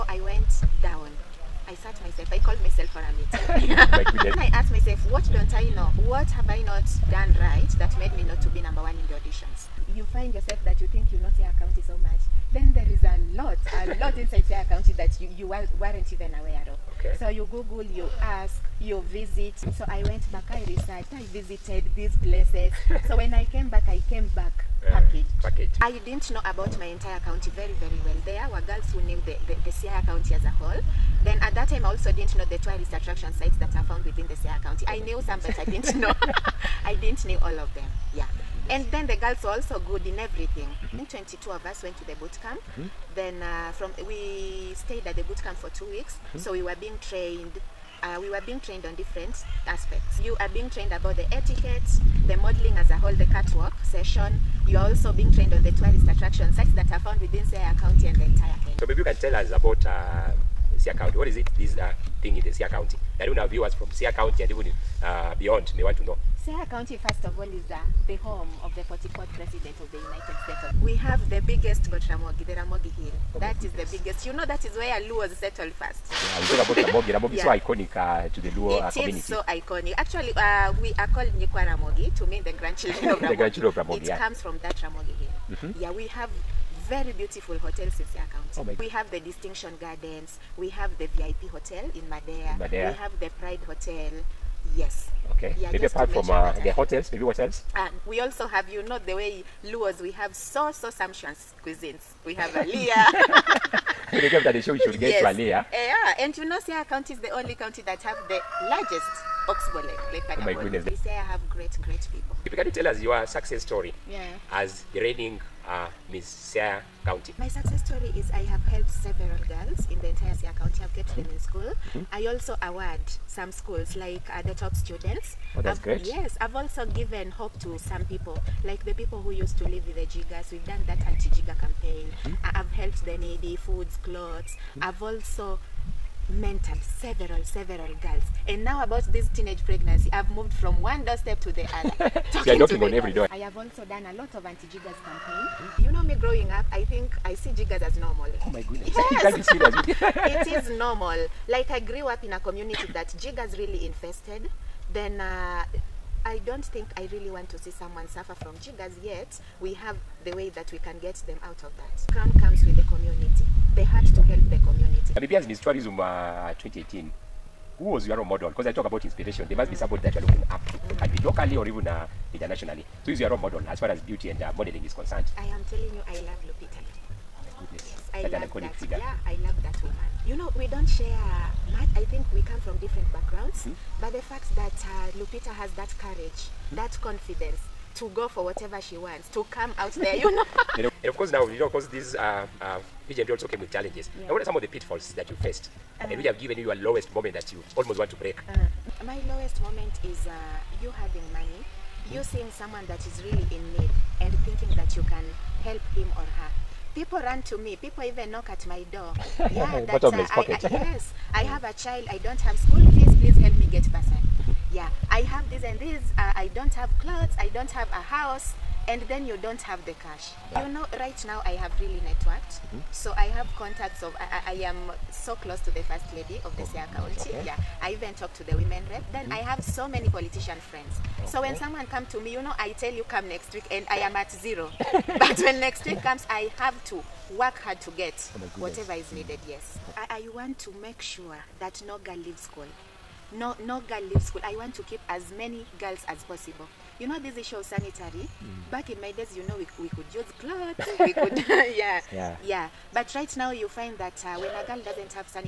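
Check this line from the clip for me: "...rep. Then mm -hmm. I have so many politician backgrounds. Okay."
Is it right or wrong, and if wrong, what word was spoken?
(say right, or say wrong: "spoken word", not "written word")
wrong: "friends", not "backgrounds".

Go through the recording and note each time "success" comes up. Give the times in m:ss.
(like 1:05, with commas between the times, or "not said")
1:53, 1:57.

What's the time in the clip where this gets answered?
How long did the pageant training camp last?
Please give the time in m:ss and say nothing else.
0:45.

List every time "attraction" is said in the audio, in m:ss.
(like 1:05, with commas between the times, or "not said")
0:32, 0:56.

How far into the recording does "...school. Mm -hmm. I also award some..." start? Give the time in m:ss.
2:01.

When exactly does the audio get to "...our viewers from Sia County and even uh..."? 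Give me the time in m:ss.
1:03.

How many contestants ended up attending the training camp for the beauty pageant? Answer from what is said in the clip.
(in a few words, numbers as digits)
22.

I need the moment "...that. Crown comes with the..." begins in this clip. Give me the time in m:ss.
2:41.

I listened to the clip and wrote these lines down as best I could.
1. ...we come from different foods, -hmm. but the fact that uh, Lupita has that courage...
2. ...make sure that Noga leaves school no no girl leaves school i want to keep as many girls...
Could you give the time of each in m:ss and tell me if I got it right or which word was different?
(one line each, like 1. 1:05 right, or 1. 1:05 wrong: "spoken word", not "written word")
1. 3:02 wrong: "backgrounds", not "foods"
2. 4:00 right.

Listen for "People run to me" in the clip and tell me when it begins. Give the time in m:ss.
3:26.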